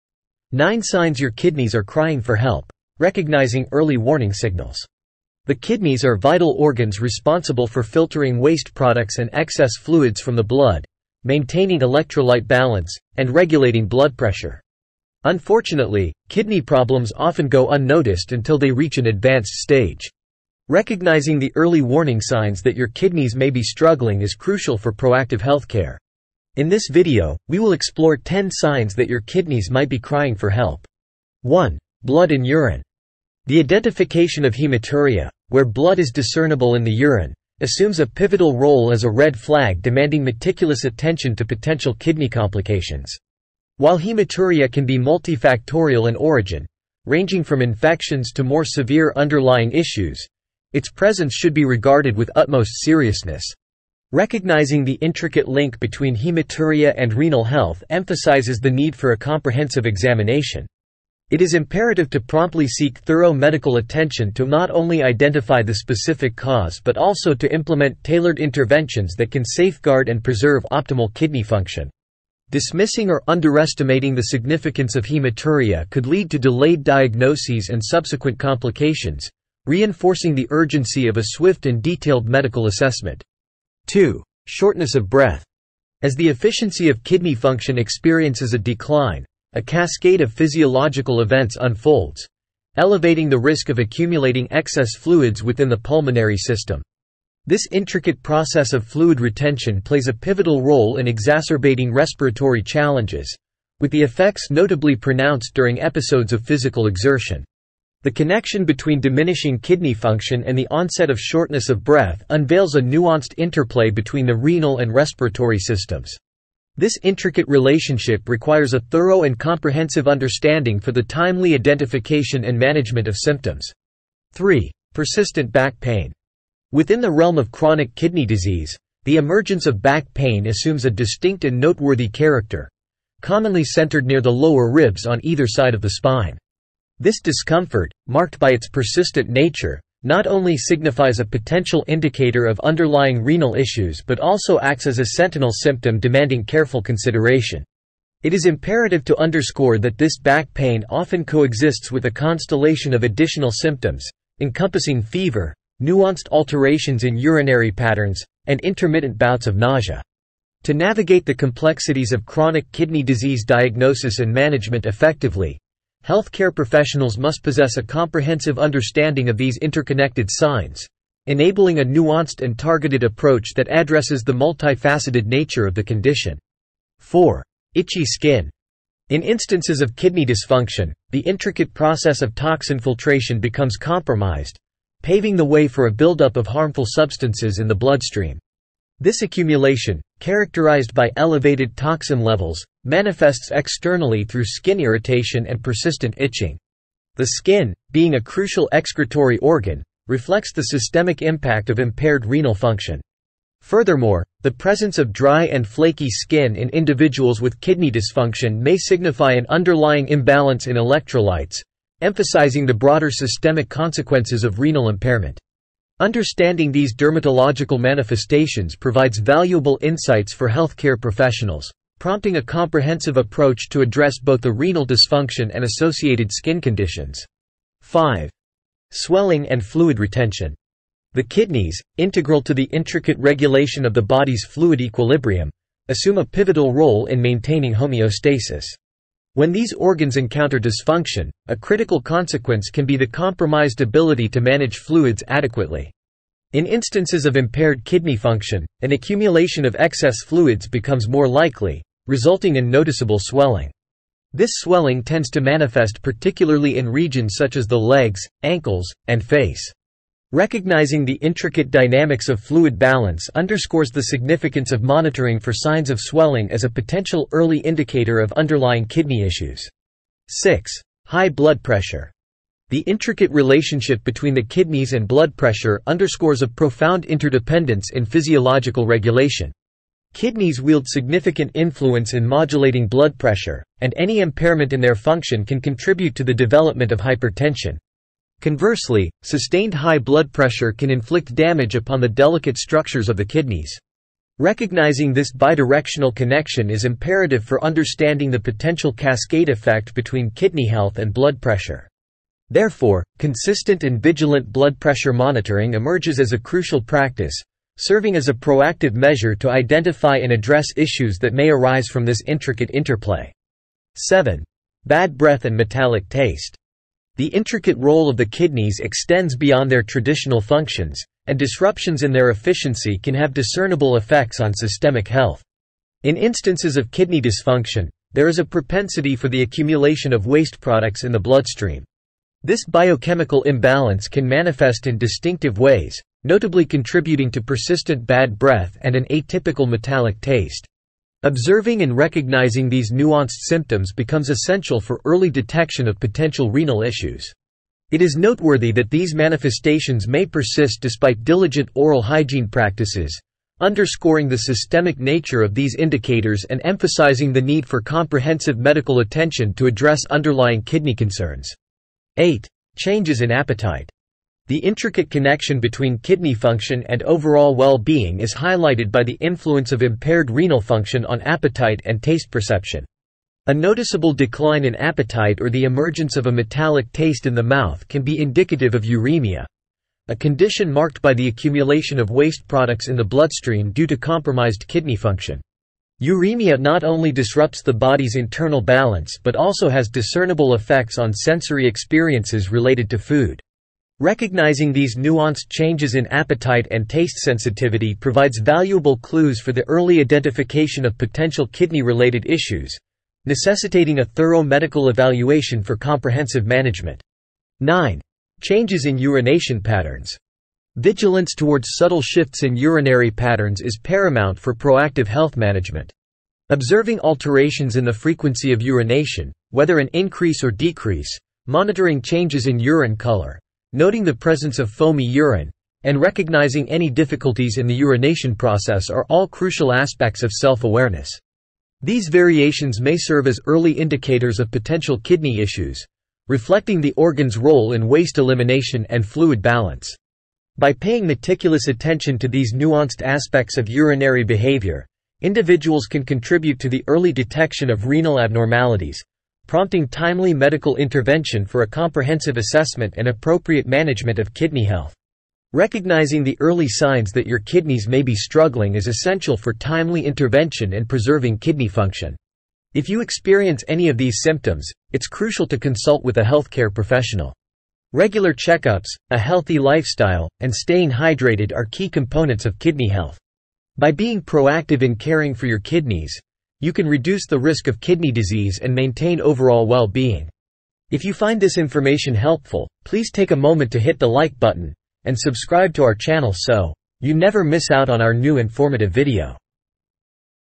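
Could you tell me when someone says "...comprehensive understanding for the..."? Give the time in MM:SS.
01:59.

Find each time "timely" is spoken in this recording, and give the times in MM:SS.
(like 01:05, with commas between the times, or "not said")
02:01, 07:29, 07:39.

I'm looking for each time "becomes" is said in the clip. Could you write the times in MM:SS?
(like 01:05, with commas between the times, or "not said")
03:03, 04:10, 05:43.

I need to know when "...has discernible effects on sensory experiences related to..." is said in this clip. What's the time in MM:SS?
06:29.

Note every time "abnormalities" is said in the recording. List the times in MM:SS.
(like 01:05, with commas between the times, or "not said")
07:28.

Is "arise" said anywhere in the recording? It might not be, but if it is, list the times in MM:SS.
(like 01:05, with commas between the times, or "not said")
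05:11.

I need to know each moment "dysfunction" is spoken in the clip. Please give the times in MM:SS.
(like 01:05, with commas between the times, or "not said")
03:00, 03:27, 03:44, 04:00, 05:27.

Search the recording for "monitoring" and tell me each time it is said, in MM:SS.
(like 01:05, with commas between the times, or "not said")
04:24, 05:05, 07:01.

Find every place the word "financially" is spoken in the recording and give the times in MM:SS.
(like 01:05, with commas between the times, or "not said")
not said.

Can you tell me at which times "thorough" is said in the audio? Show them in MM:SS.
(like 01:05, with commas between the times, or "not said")
01:02, 01:58, 06:44.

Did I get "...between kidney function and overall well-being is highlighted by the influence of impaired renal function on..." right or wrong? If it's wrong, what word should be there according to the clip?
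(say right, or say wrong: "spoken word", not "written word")
right.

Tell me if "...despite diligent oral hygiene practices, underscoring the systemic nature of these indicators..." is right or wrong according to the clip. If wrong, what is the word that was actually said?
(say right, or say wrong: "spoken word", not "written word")
right.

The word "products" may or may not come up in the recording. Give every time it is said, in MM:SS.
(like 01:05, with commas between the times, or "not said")
00:08, 05:30, 06:22.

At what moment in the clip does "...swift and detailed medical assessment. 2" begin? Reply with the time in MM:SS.
01:21.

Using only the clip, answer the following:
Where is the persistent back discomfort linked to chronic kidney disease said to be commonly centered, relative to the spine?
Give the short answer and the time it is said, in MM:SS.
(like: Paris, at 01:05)
near the lower ribs, at 02:14.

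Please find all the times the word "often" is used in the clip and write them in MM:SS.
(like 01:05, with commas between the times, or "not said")
00:17, 02:30.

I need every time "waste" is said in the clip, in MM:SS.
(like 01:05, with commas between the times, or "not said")
00:08, 05:30, 06:22, 07:17.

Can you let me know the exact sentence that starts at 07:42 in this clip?
If you experience any of these symptoms, it's crucial to consult with a healthcare professional.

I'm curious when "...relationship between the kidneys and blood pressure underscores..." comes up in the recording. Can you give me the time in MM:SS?
04:33.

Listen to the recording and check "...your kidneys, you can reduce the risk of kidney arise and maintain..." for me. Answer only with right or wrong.
wrong.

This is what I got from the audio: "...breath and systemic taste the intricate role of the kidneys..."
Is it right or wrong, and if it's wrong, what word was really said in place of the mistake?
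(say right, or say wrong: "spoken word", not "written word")
wrong: "metallic", not "systemic".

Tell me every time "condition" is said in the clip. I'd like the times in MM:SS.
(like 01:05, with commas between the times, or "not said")
02:55, 03:46, 06:20.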